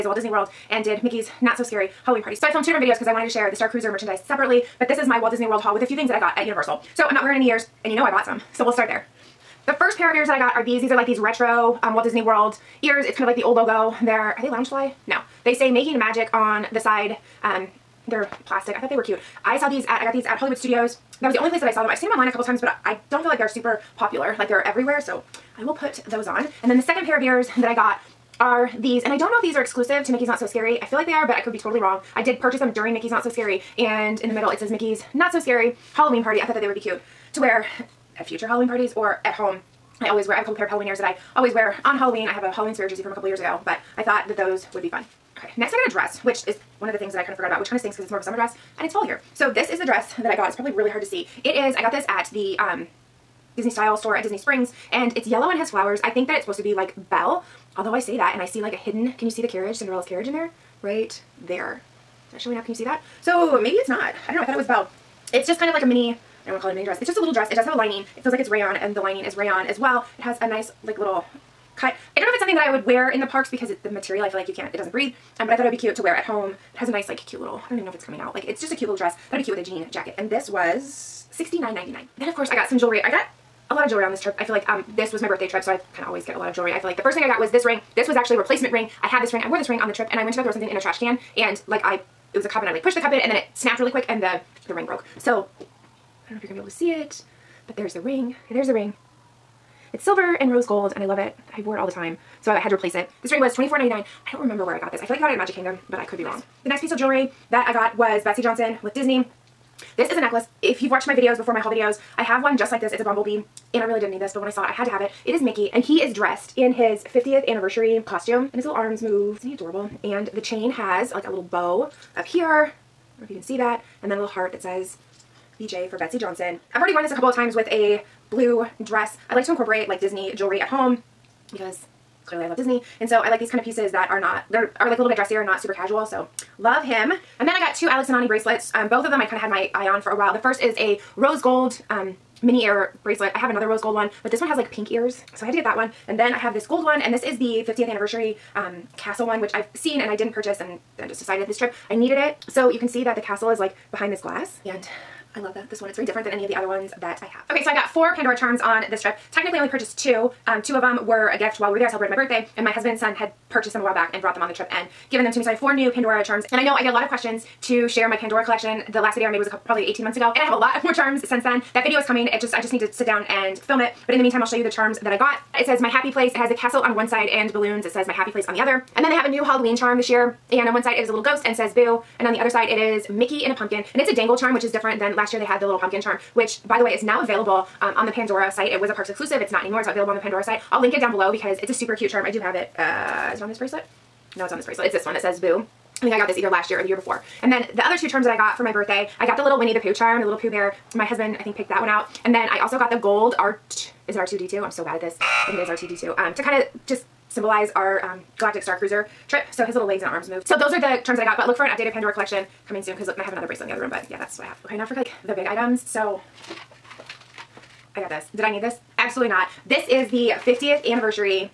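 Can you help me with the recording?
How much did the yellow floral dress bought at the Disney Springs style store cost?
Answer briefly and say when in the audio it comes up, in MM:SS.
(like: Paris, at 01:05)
$69.99, at 01:21.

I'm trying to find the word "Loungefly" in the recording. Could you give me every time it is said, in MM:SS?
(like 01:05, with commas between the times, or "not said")
00:14.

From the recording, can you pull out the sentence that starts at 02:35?
It's very different than any of the other ones that I have.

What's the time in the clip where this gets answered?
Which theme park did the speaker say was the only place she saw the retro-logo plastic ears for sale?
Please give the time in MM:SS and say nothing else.
00:20.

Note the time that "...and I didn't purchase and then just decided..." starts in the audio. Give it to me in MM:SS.
02:30.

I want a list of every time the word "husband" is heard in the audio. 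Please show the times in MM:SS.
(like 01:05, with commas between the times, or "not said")
02:42, 03:21.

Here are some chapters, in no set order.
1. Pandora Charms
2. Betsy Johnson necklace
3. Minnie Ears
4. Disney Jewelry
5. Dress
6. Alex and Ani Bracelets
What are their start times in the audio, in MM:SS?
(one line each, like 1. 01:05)
1. 02:37
2. 01:49
3. 00:07
4. 01:22
5. 00:45
6. 02:16.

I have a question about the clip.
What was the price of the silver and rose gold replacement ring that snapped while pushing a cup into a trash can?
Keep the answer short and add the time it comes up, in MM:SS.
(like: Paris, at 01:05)
$24.99, at 01:43.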